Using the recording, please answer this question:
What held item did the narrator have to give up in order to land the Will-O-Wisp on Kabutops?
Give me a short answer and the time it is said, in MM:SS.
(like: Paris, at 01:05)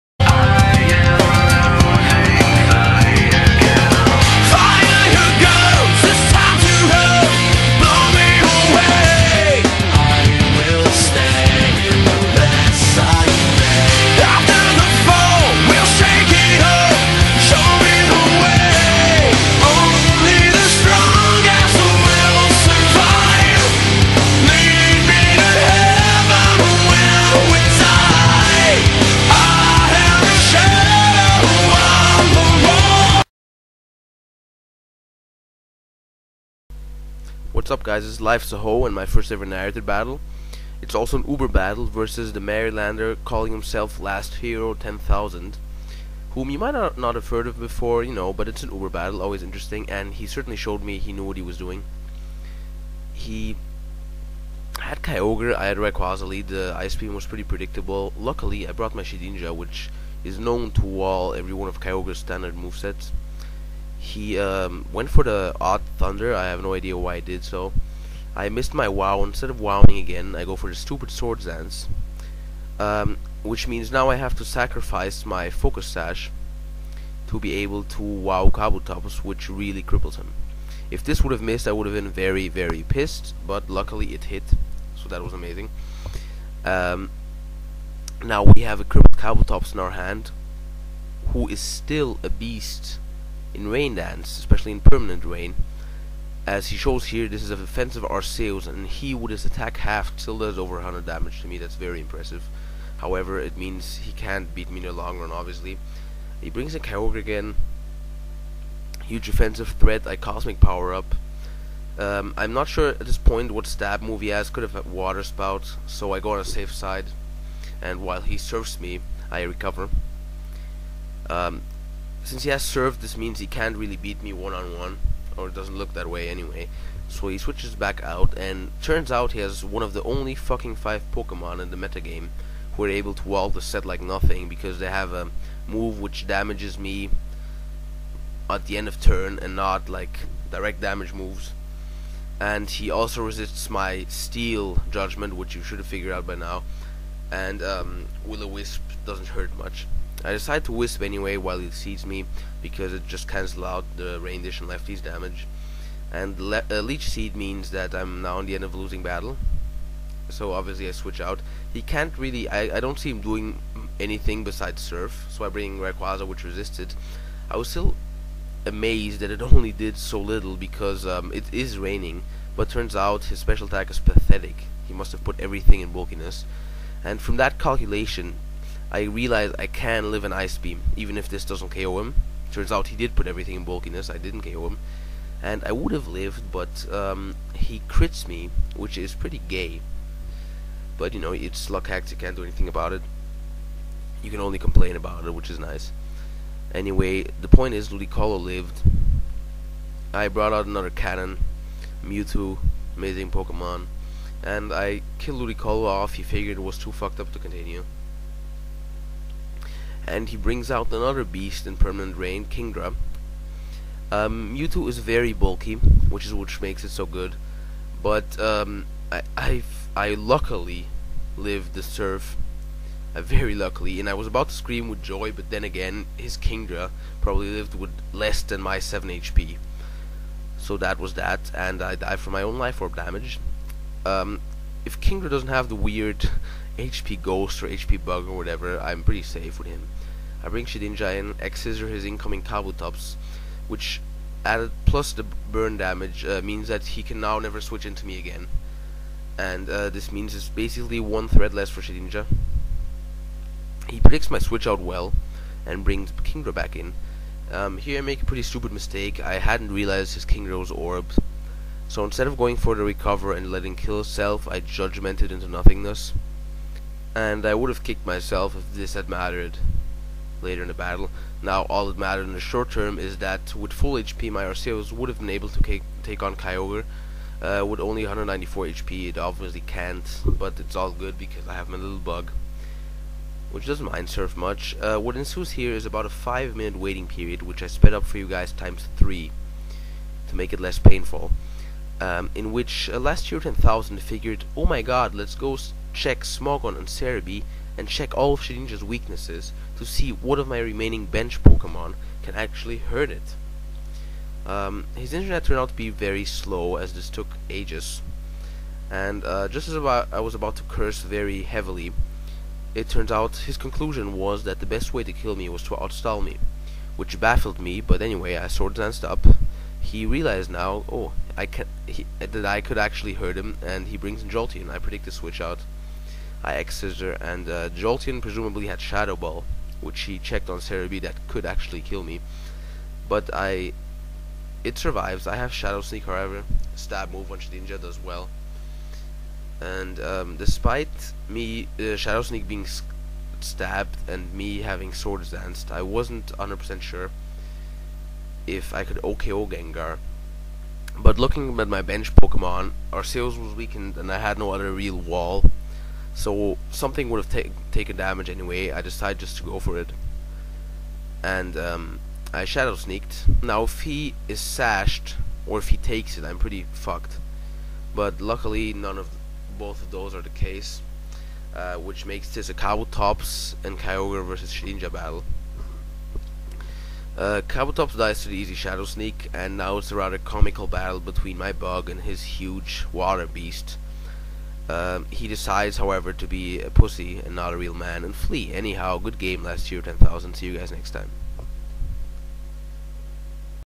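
Focus Sash, at 01:15.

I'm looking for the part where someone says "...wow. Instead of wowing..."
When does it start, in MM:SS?
01:08.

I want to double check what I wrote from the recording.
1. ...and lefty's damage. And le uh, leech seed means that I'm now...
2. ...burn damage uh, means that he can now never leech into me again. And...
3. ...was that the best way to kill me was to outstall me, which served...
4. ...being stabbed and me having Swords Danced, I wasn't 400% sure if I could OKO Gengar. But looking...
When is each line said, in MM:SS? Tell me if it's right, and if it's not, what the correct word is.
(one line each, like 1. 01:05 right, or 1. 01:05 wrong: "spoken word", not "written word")
1. 02:34 right
2. 04:05 wrong: "switch", not "leech"
3. 05:14 wrong: "baffled", not "served"
4. 05:42 wrong: "100", not "400".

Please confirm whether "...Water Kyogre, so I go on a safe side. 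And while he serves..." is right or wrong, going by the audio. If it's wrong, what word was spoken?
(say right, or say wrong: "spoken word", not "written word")
wrong: "Spout", not "Kyogre".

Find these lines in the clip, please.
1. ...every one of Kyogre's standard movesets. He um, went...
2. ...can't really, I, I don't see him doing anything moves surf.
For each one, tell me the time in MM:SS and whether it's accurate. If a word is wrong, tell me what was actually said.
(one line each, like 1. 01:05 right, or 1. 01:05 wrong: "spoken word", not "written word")
1. 01:01 right
2. 02:41 wrong: "besides", not "moves".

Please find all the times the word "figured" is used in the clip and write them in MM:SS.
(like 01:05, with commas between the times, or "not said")
02:25, 03:26, 04:54.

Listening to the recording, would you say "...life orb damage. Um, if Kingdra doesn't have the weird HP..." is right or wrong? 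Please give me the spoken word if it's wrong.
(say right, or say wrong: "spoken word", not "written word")
right.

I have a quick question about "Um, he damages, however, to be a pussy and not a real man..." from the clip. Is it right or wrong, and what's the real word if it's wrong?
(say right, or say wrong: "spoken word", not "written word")
wrong: "decides", not "damages".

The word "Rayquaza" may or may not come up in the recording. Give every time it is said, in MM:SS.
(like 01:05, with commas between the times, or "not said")
00:55, 02:45.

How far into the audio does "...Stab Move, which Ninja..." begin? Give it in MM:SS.
05:36.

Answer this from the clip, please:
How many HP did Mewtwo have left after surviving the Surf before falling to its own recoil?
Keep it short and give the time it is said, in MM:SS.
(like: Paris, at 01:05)
7, at 03:48.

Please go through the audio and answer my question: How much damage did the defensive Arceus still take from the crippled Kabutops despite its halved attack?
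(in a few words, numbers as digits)
over 100.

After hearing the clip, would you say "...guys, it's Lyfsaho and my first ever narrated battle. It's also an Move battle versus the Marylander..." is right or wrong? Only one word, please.
wrong.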